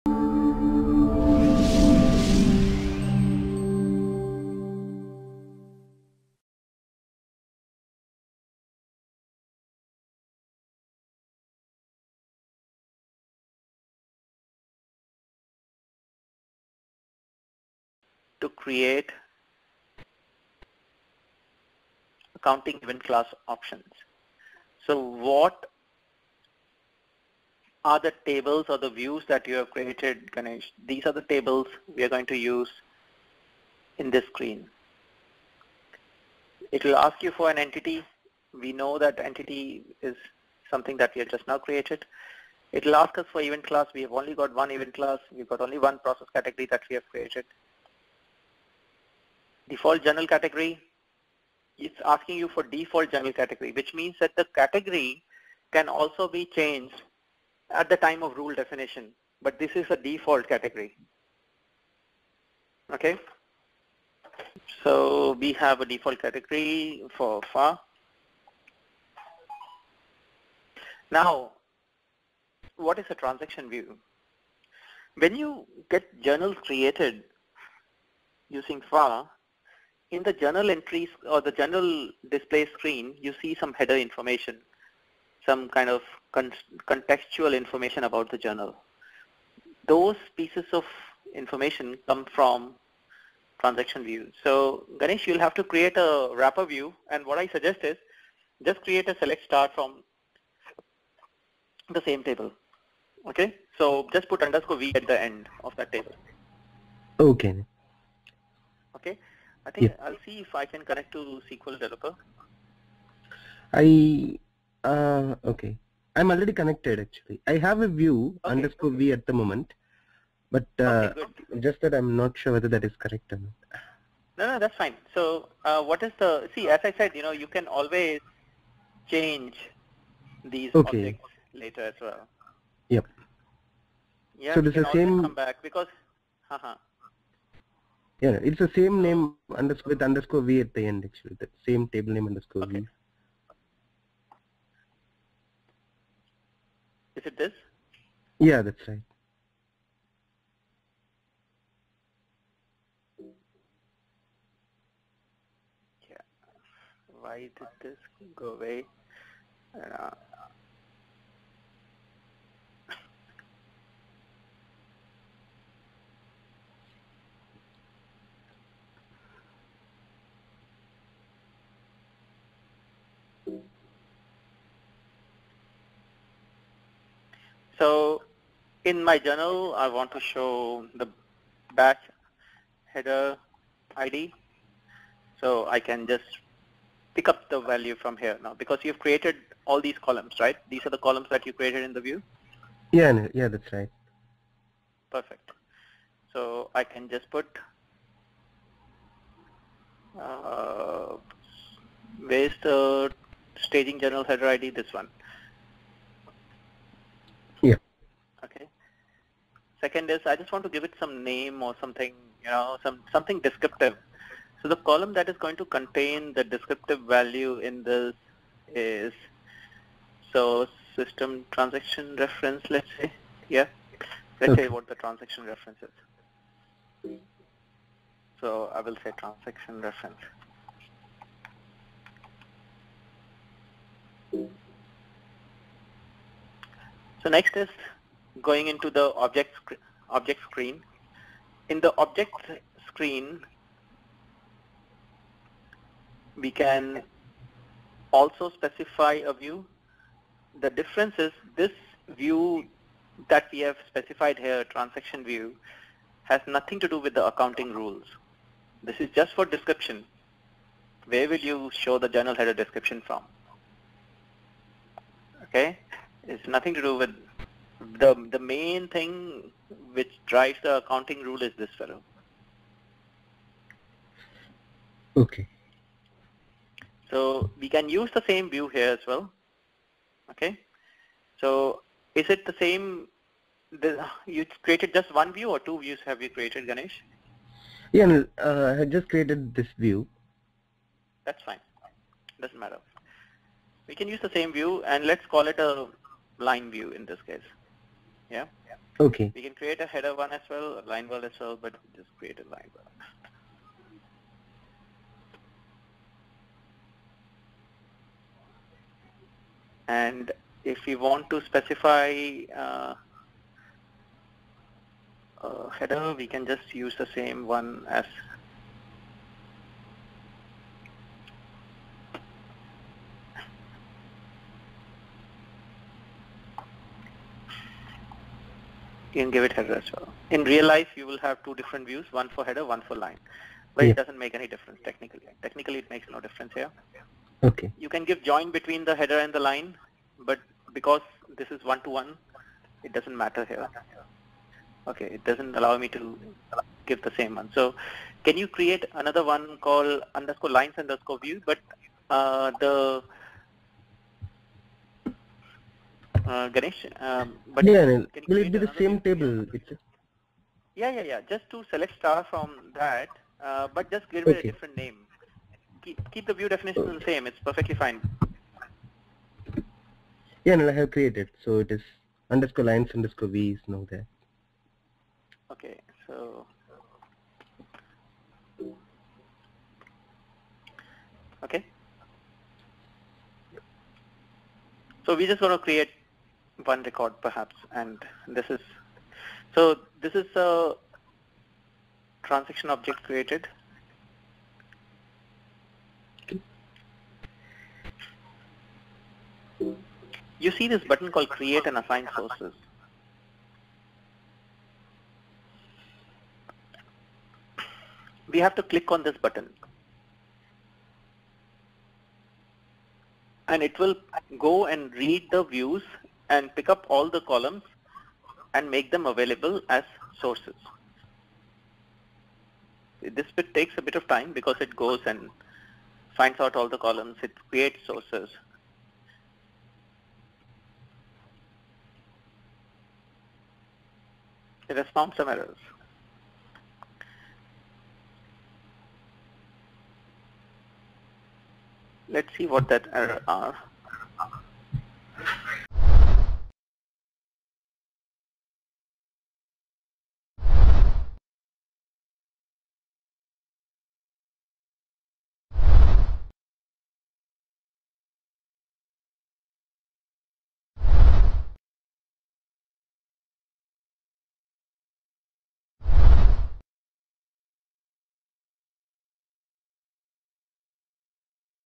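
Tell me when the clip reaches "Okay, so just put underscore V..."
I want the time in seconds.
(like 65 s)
103 s.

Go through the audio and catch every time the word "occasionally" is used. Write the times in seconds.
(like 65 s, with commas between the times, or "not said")
not said.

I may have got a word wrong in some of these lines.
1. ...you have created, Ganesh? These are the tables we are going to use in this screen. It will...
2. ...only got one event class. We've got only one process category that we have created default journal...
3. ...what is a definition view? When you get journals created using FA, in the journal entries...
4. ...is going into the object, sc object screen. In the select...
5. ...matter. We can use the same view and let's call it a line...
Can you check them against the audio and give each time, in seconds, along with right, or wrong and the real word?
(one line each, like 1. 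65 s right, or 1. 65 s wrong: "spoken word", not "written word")
1. 29 s right
2. 44 s right
3. 72 s wrong: "transaction", not "definition"
4. 237 s wrong: "object", not "select"
5. 292 s right.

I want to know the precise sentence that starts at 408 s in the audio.
We have to click on this button.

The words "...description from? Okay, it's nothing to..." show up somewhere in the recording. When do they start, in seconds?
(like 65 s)
262 s.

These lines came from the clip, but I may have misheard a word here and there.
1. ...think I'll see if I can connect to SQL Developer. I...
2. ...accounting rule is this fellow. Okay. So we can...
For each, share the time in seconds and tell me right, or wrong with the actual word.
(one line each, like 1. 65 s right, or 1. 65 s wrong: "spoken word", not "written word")
1. 109 s right
2. 270 s right.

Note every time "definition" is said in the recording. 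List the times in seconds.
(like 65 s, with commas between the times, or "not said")
58 s, 366 s.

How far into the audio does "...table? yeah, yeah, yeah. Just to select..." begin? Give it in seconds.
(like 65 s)
359 s.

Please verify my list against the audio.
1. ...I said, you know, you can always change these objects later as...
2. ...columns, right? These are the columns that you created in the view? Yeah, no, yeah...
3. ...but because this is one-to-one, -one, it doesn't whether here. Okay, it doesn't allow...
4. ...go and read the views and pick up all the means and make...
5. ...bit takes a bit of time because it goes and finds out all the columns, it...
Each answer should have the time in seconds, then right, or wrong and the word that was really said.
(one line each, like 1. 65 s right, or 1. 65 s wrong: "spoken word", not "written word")
1. 126 s right
2. 189 s right
3. 340 s wrong: "matter", not "whether"
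4. 414 s wrong: "columns", not "means"
5. 423 s right.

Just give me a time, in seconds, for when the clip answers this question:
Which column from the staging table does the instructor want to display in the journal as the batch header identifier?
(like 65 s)
203 s.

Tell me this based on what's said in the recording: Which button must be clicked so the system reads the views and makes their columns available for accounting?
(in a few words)
Create and assign sources.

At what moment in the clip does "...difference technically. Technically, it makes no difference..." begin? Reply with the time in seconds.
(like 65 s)
334 s.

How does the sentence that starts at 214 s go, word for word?
So the column that is going to contain the descriptive value in this is, so system transaction reference, let's say, yeah.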